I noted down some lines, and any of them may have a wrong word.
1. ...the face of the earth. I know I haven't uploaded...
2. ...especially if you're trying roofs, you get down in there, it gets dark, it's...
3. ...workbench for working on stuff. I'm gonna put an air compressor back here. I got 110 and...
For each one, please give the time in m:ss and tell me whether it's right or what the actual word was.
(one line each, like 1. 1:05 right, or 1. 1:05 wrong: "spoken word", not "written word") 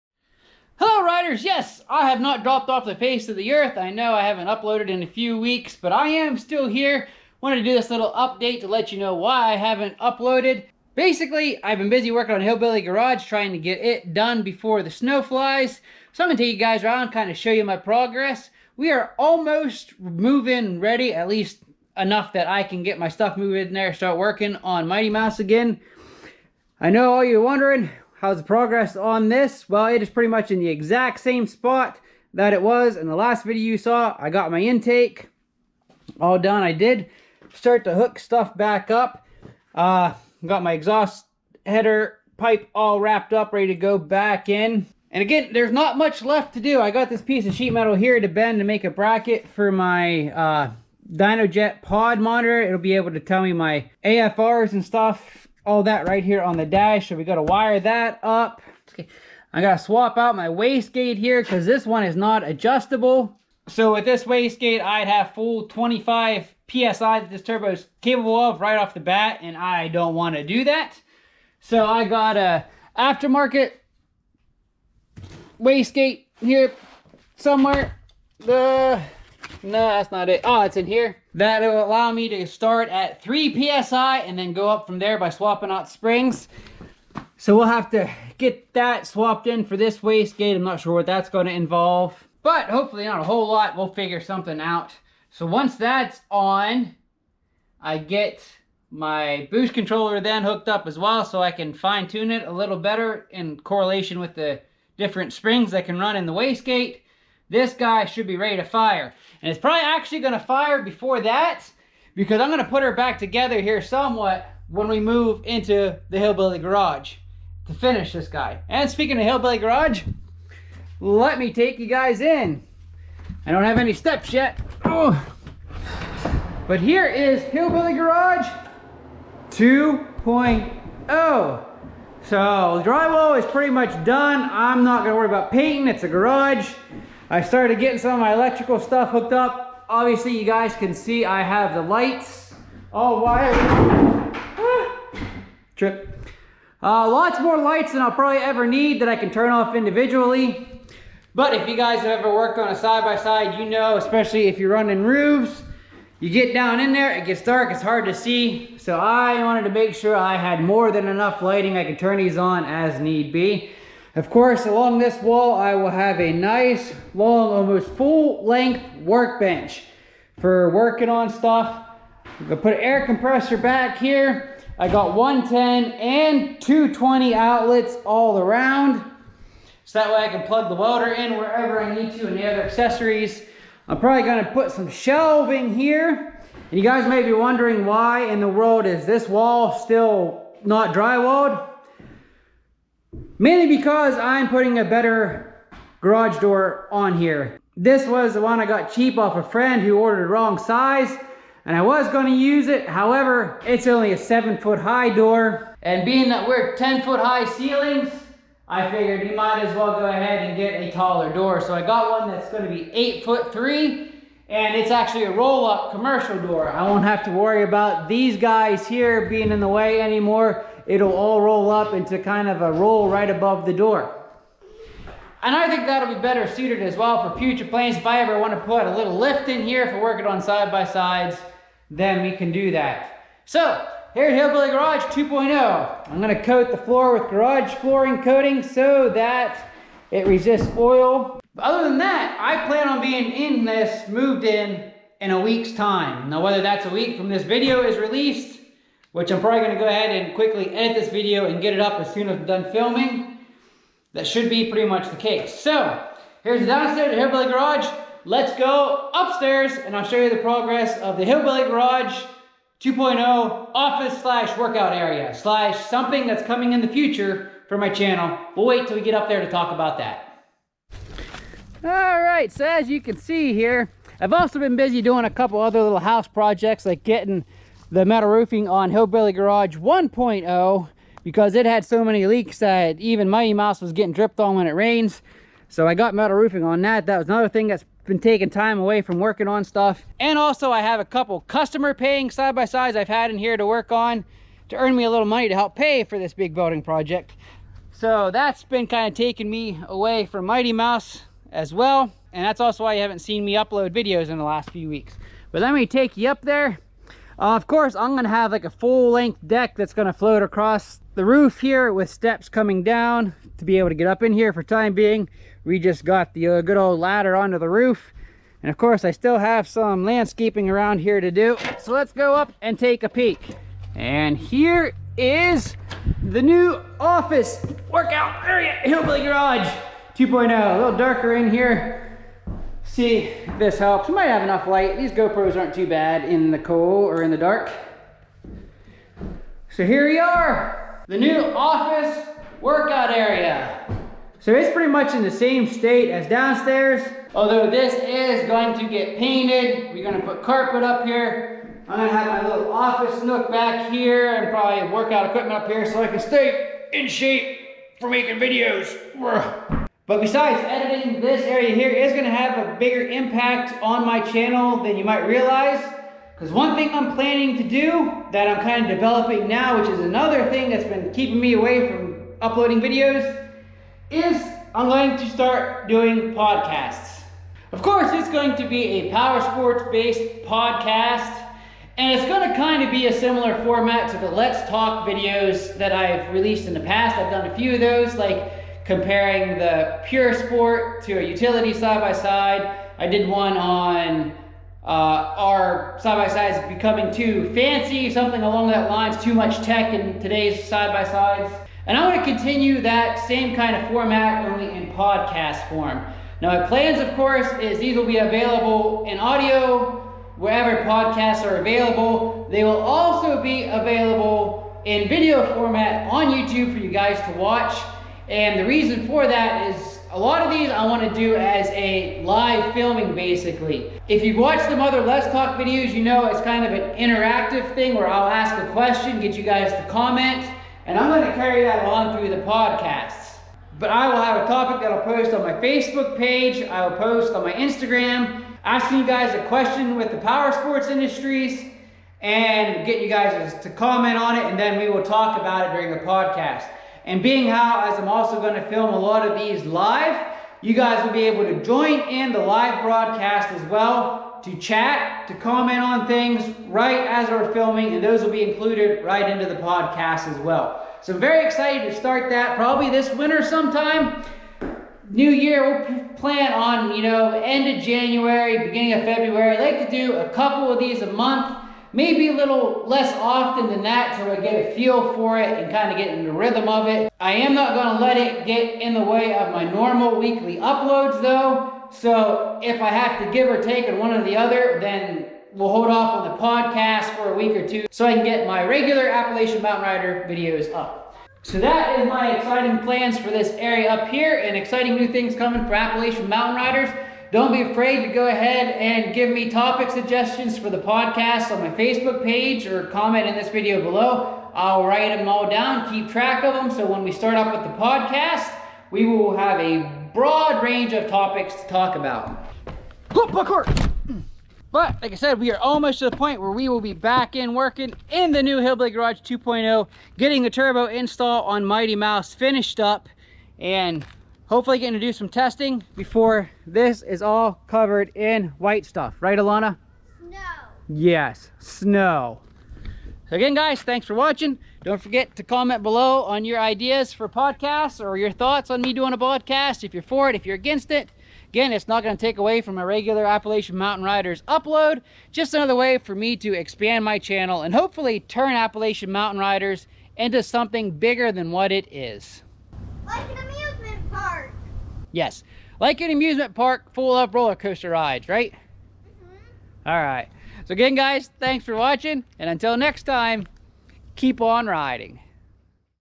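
1. 0:02 right
2. 2:33 wrong: "running", not "trying"
3. 2:49 right.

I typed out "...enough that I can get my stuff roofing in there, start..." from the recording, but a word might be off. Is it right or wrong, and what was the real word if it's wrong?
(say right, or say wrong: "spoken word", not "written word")
wrong: "moving", not "roofing".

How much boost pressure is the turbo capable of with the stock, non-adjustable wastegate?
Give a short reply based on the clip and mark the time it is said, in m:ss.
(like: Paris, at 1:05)
25 PSI, at 1:05.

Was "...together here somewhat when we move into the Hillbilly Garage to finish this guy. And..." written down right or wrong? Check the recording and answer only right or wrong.
right.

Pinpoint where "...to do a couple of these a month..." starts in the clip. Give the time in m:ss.
7:49.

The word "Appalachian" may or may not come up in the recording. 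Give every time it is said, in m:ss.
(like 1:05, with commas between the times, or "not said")
8:09, 8:15, 9:03, 9:08.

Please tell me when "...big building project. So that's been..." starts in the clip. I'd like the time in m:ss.
4:56.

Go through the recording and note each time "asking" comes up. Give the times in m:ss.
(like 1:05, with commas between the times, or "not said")
7:18.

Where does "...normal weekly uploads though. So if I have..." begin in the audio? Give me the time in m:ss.
7:59.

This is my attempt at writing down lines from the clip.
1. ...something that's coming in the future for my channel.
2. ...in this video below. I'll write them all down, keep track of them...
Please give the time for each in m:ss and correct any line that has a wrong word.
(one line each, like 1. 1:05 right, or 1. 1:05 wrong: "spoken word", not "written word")
1. 4:25 right
2. 8:23 right.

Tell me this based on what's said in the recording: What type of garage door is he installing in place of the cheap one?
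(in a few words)
roll up commercial door.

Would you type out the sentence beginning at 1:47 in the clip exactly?
This guy should be ready to fire.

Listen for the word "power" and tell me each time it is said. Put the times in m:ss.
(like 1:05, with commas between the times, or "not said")
6:19, 7:20.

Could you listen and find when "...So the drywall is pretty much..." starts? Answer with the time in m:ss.
2:11.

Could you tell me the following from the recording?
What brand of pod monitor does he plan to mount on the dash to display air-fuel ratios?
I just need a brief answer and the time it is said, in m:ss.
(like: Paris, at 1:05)
Dynojet, at 0:51.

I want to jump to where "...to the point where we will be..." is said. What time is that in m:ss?
8:35.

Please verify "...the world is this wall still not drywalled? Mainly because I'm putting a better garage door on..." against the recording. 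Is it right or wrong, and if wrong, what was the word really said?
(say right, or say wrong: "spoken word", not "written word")
right.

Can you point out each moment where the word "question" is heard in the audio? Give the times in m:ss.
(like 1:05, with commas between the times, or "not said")
7:08, 7:19.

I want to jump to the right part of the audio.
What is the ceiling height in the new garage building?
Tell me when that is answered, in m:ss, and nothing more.
3:26.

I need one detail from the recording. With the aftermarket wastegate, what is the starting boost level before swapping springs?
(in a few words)
3 PSI.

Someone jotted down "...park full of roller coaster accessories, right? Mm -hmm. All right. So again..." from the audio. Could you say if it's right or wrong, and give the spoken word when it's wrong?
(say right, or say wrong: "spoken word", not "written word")
wrong: "rides", not "accessories".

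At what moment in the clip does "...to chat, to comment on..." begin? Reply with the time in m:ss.
7:34.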